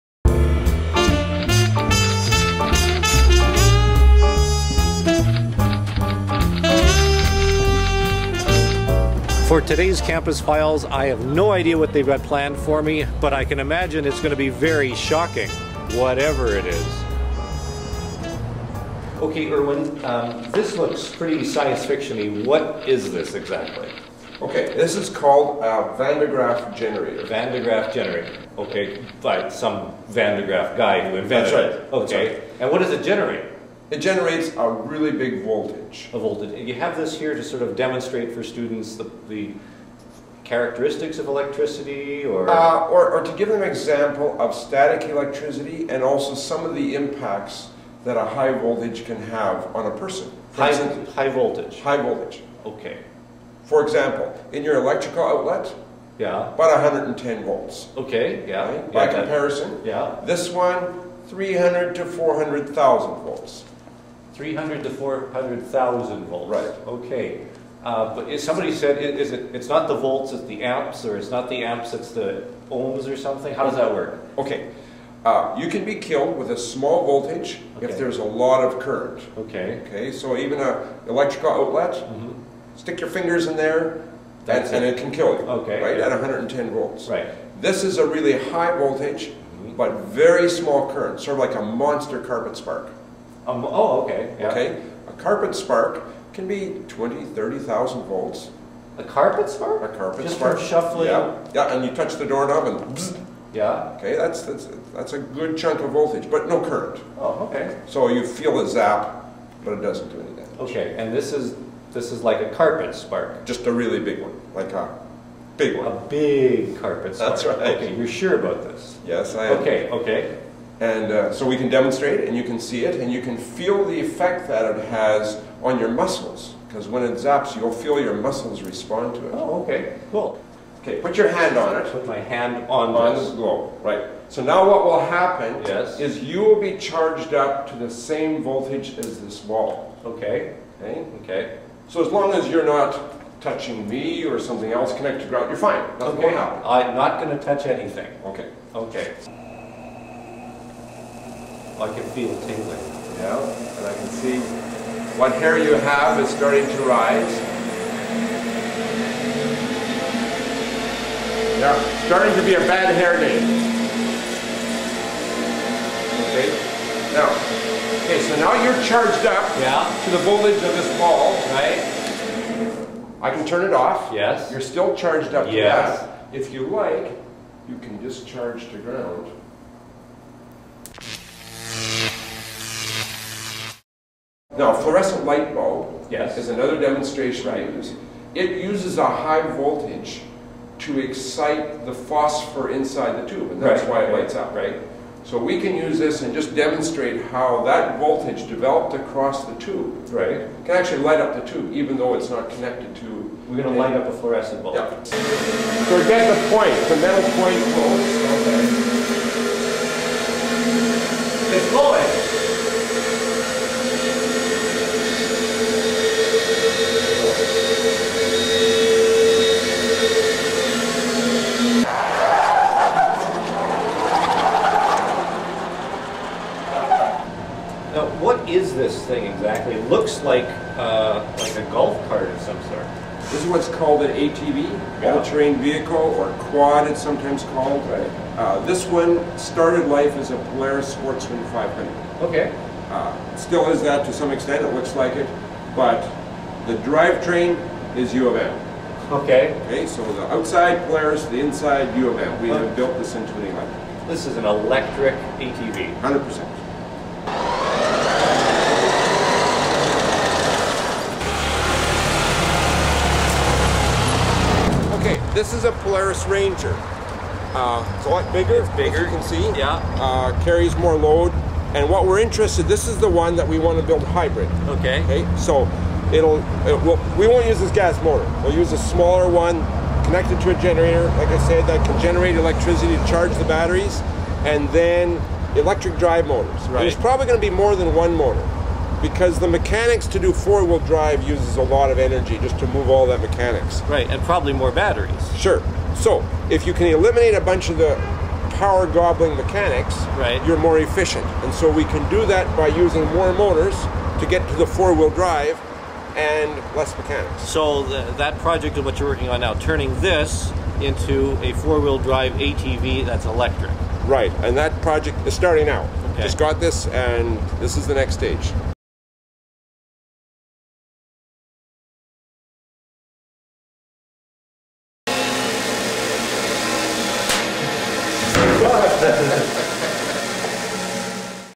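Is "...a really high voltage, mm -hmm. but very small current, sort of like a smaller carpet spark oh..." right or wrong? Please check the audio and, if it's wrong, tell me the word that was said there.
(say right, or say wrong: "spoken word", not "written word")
wrong: "monster", not "smaller".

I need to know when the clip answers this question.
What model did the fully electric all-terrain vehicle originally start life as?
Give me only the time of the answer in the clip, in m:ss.
4:00.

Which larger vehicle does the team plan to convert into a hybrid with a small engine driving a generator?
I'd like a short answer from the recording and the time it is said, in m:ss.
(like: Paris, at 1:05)
Polaris Ranger, at 4:25.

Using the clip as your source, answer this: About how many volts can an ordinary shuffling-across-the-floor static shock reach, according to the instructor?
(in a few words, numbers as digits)
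20,000 to 30,000 volts.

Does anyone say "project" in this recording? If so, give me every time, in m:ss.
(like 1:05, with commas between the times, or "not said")
5:08, 5:14.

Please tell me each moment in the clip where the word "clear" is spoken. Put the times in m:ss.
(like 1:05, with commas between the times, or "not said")
not said.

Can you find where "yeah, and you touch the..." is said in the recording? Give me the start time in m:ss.
1:41.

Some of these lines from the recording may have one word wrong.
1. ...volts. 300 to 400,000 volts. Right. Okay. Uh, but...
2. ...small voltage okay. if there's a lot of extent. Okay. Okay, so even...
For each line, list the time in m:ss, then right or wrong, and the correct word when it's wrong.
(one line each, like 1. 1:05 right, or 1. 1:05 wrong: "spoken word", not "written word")
1. 1:03 right
2. 1:16 wrong: "current", not "extent".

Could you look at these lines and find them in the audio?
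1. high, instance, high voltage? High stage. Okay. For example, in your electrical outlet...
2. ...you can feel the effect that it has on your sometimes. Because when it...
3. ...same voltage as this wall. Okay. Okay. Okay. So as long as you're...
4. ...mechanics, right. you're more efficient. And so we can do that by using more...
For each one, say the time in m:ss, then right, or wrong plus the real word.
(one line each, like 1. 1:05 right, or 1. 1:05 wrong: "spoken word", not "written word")
1. 0:50 wrong: "voltage", not "stage"
2. 2:03 wrong: "muscles", not "sometimes"
3. 2:17 right
4. 4:59 right.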